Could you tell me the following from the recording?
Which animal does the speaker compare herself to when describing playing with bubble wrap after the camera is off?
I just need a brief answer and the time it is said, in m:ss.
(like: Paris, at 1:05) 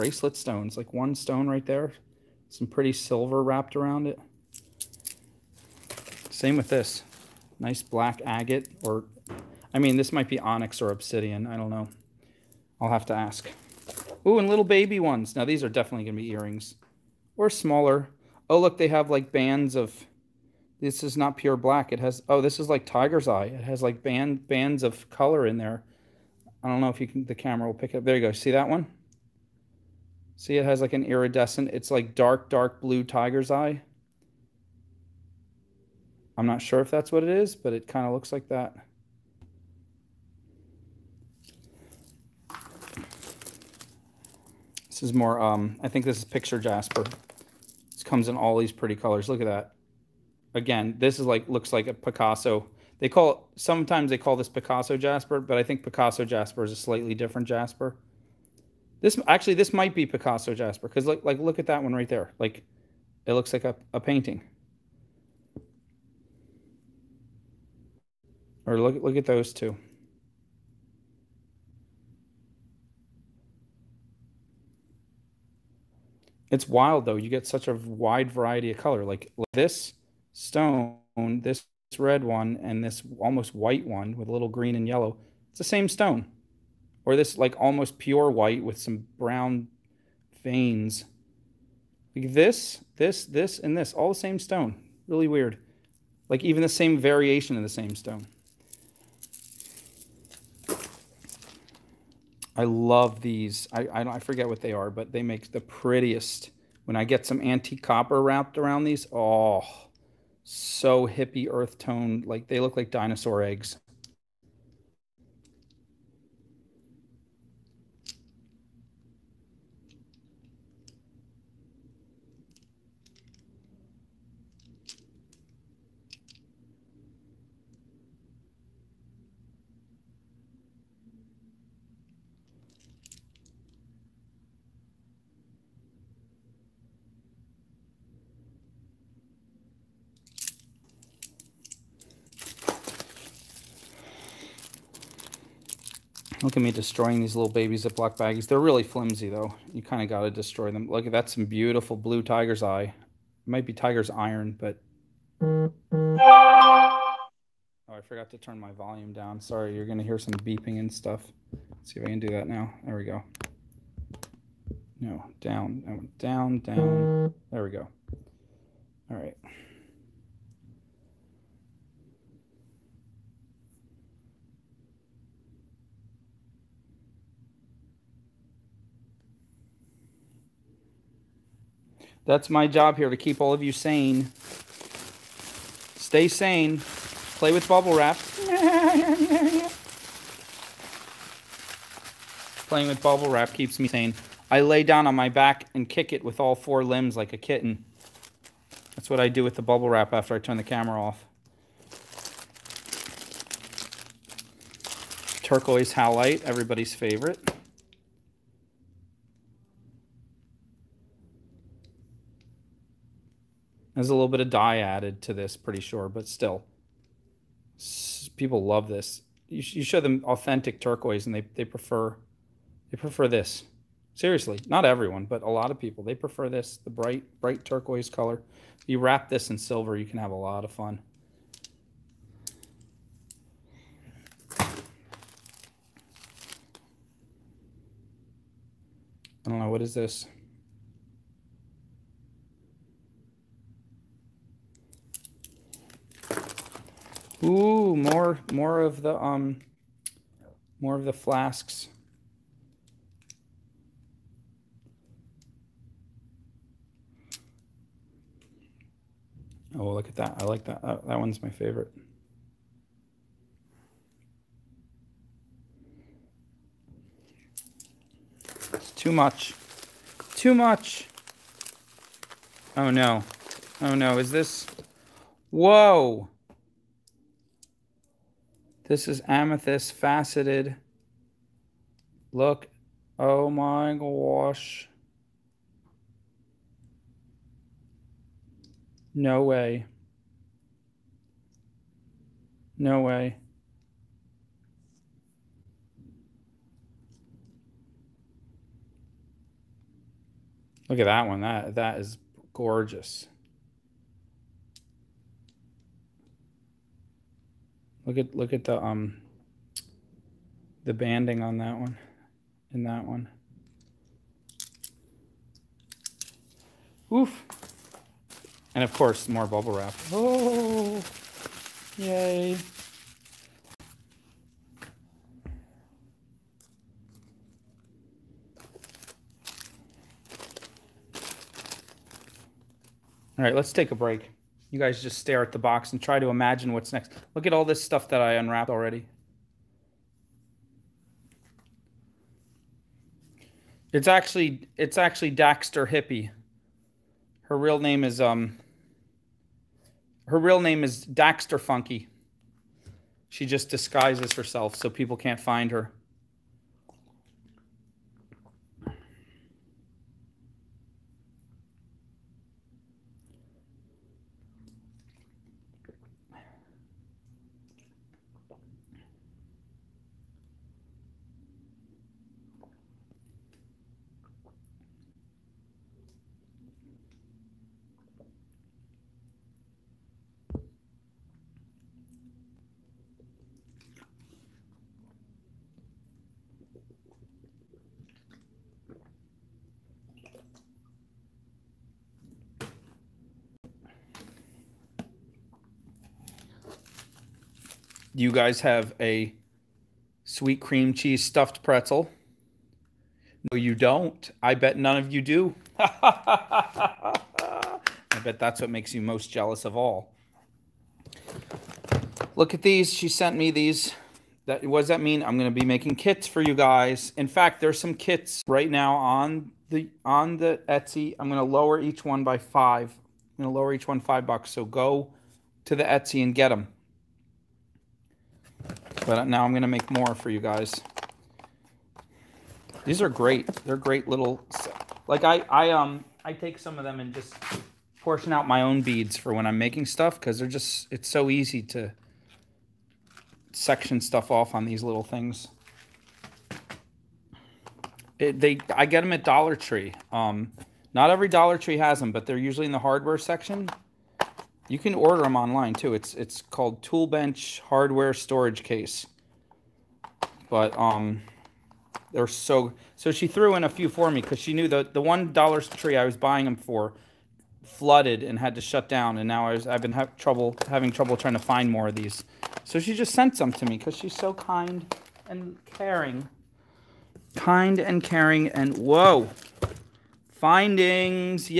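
a kitten, at 3:17.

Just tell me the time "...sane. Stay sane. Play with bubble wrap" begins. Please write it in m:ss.
3:03.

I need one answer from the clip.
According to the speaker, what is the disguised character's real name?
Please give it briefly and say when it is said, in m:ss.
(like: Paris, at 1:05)
Daxter Funky, at 5:51.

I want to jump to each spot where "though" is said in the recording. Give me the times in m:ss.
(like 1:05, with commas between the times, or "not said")
1:17, 2:29.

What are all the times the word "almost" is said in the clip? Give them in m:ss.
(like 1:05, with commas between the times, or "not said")
1:23, 1:27.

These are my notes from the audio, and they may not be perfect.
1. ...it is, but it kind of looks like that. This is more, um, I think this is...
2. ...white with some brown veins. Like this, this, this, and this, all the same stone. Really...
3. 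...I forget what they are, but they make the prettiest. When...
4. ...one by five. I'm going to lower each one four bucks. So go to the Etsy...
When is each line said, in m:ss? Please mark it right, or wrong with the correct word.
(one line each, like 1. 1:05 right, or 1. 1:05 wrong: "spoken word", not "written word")
1. 0:37 right
2. 1:28 right
3. 1:44 right
4. 7:02 wrong: "five", not "four".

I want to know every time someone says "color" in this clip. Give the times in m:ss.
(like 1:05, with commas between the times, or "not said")
0:25, 0:48, 1:18, 3:48.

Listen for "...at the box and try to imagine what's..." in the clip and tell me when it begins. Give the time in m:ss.
5:35.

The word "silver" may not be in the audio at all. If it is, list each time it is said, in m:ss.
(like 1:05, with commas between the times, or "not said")
0:02, 3:49.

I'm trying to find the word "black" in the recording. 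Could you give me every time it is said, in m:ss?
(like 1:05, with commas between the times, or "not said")
0:07, 0:21.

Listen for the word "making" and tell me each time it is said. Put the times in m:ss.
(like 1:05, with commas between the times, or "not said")
6:55, 7:19.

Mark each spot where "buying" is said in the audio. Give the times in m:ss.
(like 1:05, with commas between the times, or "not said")
7:46.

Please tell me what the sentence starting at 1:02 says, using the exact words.
Like it looks like a, a painting.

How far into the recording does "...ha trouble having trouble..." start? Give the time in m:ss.
7:49.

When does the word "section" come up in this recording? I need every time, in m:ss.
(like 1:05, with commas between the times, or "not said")
7:23, 7:33.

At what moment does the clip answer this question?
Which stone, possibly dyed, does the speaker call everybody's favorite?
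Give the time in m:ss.
3:25.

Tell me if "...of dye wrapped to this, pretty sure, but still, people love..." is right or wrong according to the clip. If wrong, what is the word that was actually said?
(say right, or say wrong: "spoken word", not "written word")
wrong: "added", not "wrapped".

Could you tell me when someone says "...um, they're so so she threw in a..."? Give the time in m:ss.
7:40.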